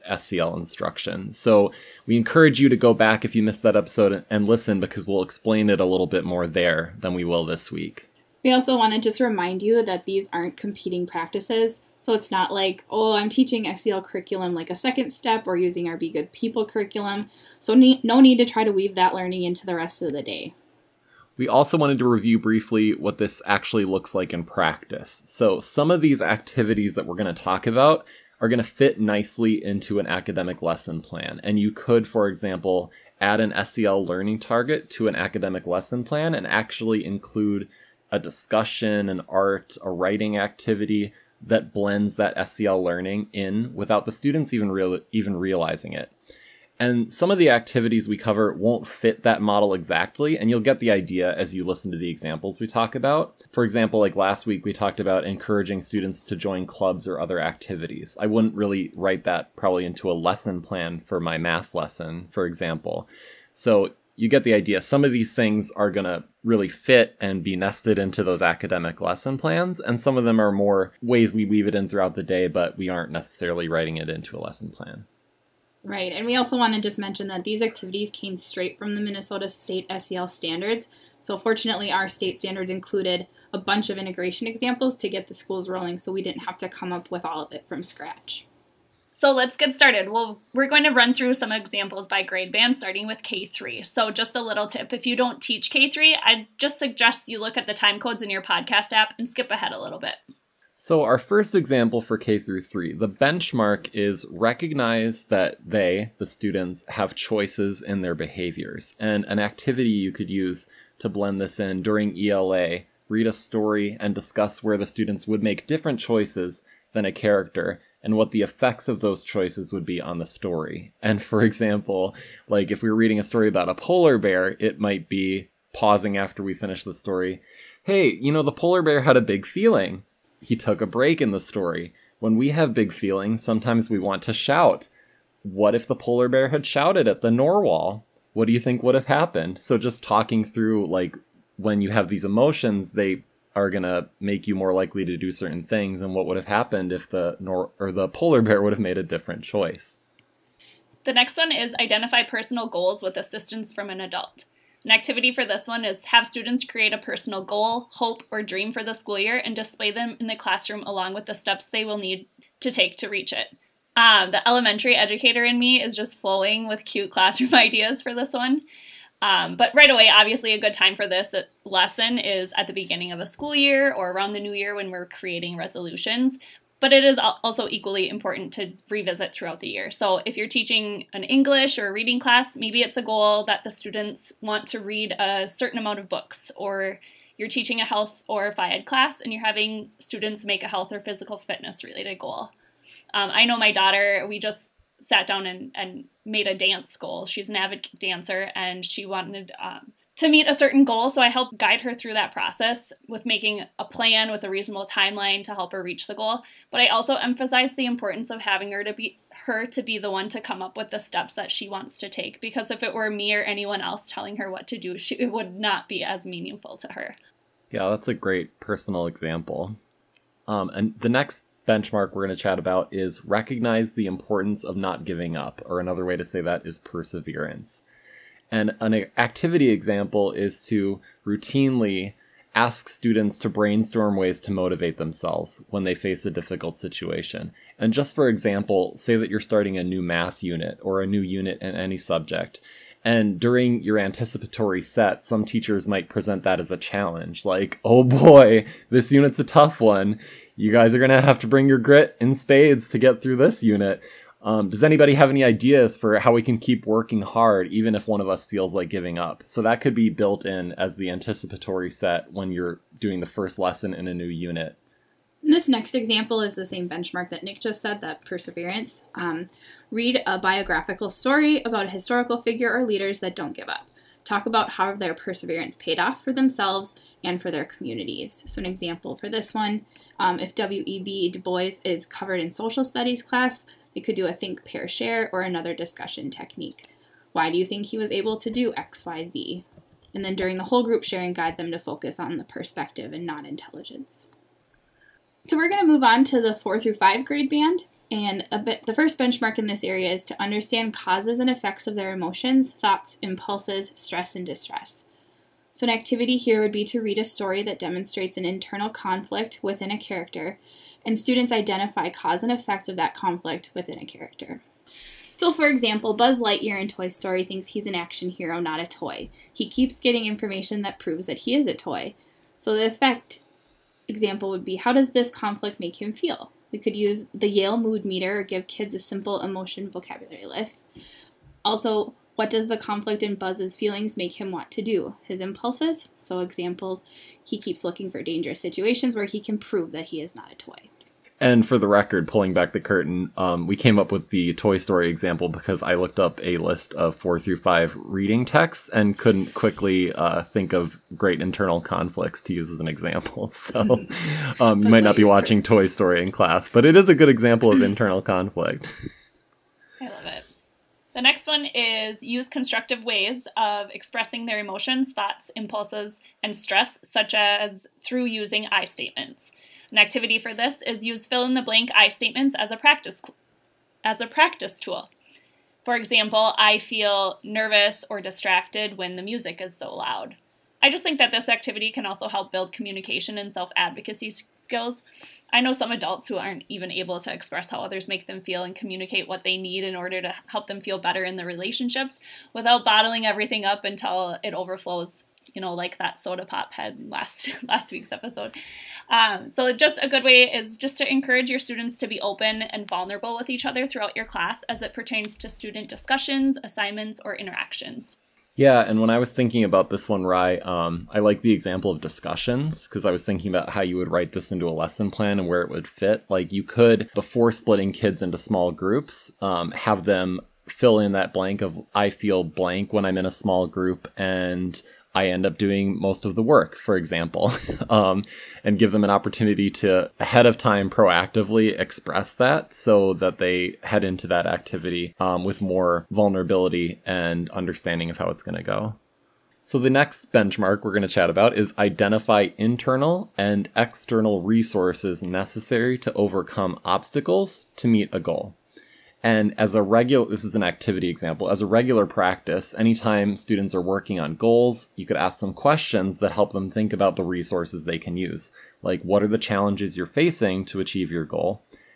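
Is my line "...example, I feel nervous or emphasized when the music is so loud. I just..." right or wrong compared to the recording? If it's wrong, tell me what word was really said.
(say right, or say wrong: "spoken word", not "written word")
wrong: "distracted", not "emphasized".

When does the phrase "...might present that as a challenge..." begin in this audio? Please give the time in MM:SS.
04:05.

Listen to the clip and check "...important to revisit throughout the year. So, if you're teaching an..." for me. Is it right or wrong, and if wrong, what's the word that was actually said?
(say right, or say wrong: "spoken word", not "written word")
right.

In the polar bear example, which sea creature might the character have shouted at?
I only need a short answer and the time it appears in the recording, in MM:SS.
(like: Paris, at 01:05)
narwhal, at 02:17.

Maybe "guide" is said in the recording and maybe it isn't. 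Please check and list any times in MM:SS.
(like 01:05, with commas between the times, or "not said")
03:21, 04:51.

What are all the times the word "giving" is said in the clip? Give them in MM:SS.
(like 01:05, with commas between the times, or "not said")
03:45, 04:18.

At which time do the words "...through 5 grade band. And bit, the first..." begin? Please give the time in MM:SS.
04:56.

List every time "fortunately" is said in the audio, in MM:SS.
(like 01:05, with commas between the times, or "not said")
01:21.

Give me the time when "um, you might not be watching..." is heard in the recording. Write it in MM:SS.
05:54.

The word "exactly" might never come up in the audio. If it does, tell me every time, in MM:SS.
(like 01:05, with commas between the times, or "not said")
00:49.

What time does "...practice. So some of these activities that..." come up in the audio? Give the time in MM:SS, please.
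00:24.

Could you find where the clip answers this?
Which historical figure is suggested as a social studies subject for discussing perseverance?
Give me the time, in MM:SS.
04:40.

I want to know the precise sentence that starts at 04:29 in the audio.
Um, read a biographical story about a historical figure or leaders that don't give up.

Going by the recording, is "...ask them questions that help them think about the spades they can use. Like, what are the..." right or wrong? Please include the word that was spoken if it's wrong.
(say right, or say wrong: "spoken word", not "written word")
wrong: "resources", not "spades".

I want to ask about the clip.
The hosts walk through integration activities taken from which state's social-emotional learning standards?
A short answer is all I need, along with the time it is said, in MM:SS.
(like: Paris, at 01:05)
Minnesota, at 01:19.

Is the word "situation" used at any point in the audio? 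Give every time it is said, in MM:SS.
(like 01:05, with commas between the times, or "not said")
03:56, 05:38.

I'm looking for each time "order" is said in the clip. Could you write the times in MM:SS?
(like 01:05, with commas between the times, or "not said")
06:29.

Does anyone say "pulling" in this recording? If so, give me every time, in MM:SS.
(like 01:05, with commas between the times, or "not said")
05:42.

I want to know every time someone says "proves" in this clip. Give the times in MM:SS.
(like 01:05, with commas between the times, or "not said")
05:20, 05:39.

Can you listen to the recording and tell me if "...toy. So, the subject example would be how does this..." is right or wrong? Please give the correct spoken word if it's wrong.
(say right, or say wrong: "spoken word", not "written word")
wrong: "effect", not "subject".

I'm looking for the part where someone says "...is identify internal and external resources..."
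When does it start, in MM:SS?
07:21.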